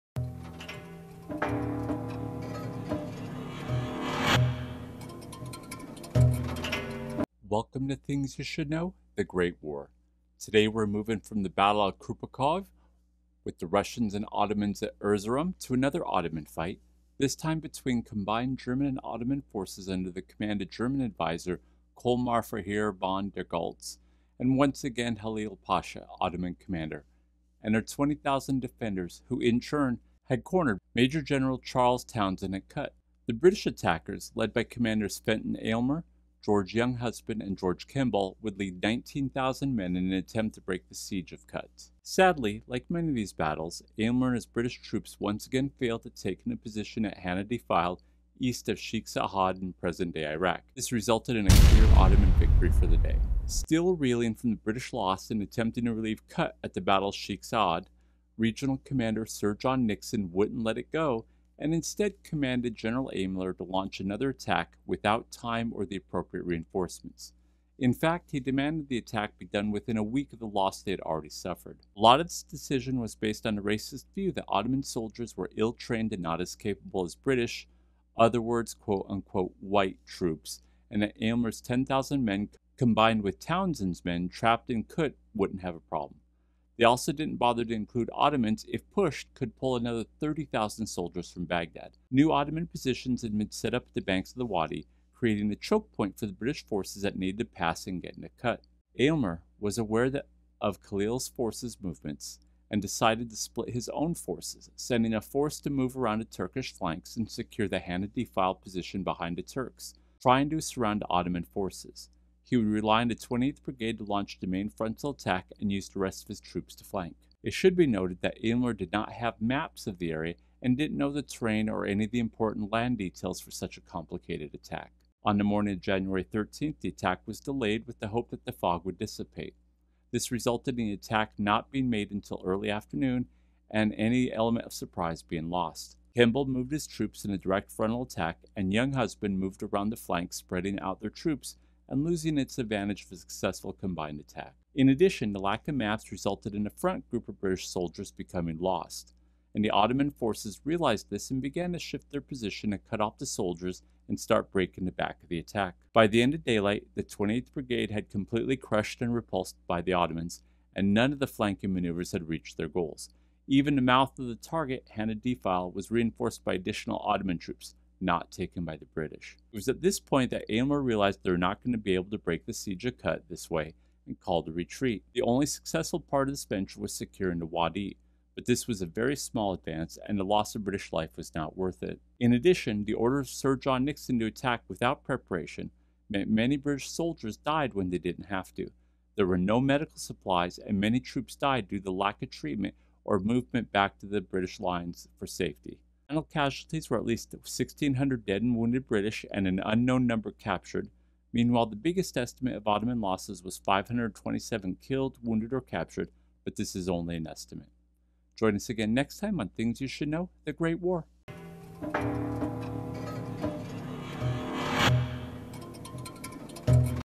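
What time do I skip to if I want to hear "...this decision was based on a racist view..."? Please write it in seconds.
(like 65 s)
72 s.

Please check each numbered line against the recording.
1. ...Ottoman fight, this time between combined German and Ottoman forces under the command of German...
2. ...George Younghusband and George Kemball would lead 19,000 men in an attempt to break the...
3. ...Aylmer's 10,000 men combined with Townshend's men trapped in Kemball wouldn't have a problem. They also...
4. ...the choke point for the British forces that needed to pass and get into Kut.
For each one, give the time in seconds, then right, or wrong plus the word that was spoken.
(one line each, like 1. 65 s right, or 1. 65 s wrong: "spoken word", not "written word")
1. 16 s right
2. 36 s right
3. 81 s wrong: "Kut", not "Kemball"
4. 95 s right.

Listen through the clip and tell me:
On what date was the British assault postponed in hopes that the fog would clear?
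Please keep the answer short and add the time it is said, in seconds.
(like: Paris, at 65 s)
January 13th, at 125 s.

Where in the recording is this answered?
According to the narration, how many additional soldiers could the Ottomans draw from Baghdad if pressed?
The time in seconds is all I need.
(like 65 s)
90 s.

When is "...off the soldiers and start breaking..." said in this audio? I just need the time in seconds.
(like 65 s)
153 s.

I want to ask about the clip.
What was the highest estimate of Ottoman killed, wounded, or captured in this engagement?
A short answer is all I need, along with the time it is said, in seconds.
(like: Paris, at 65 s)
527, at 203 s.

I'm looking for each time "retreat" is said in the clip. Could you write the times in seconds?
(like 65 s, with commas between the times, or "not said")
174 s.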